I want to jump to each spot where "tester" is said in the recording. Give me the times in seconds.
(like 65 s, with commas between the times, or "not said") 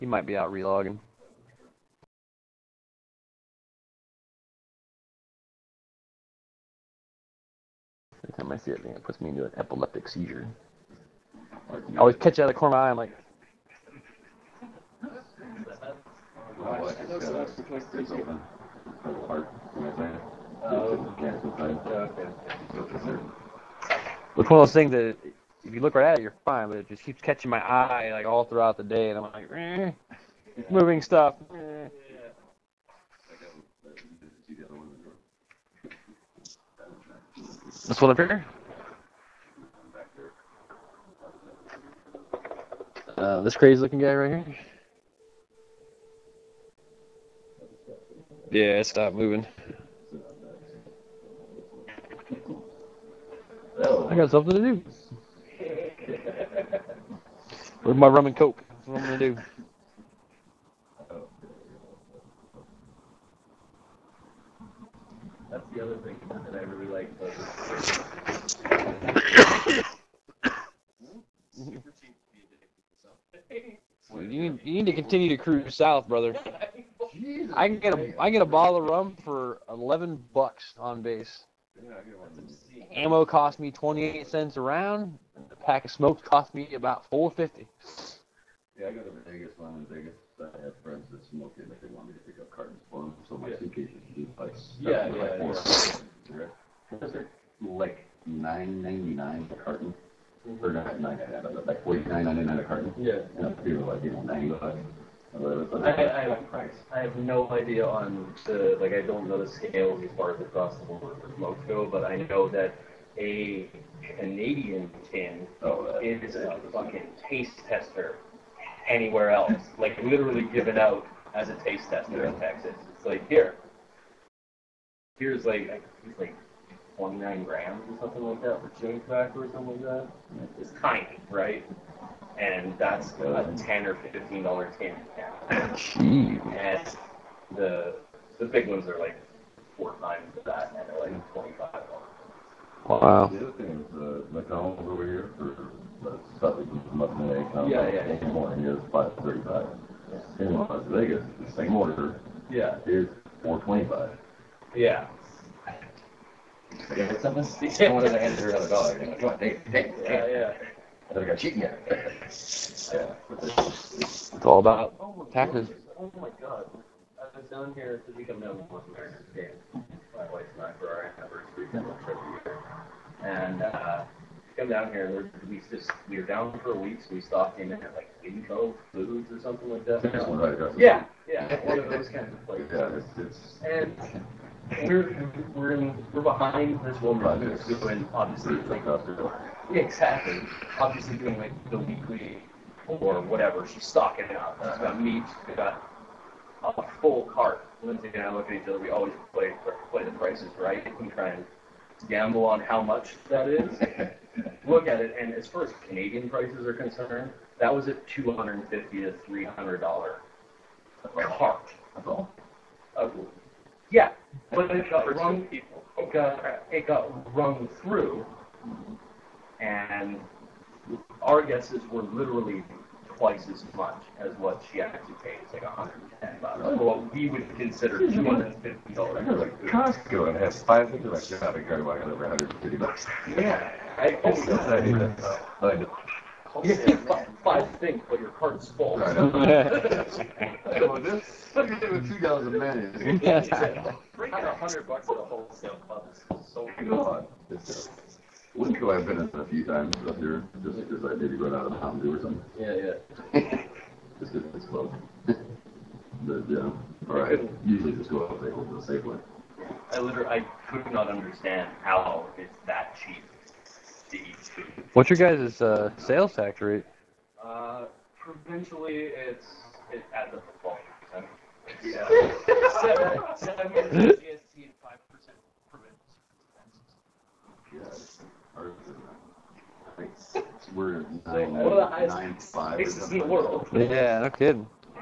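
117 s, 121 s.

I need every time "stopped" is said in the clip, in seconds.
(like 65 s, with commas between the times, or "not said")
48 s, 177 s.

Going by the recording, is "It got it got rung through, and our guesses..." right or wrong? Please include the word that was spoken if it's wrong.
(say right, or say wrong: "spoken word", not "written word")
right.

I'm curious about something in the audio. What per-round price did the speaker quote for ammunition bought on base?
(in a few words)
28 cents.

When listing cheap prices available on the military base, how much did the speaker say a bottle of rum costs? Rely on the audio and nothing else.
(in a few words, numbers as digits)
$11.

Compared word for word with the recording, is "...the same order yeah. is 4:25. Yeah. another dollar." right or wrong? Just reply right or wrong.
right.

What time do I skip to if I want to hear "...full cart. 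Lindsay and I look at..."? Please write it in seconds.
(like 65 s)
197 s.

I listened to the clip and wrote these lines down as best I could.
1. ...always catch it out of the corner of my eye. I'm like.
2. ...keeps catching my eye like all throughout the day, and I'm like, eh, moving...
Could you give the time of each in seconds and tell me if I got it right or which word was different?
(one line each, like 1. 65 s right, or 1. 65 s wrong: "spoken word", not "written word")
1. 11 s right
2. 27 s right.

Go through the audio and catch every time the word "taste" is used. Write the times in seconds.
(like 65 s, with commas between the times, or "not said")
117 s, 121 s.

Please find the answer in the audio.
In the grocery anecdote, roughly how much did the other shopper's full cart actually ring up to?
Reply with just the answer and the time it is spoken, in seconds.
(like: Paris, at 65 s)
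$110, at 225 s.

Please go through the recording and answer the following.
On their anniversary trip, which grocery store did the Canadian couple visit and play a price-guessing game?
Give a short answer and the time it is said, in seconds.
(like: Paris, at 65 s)
Winco Foods, at 178 s.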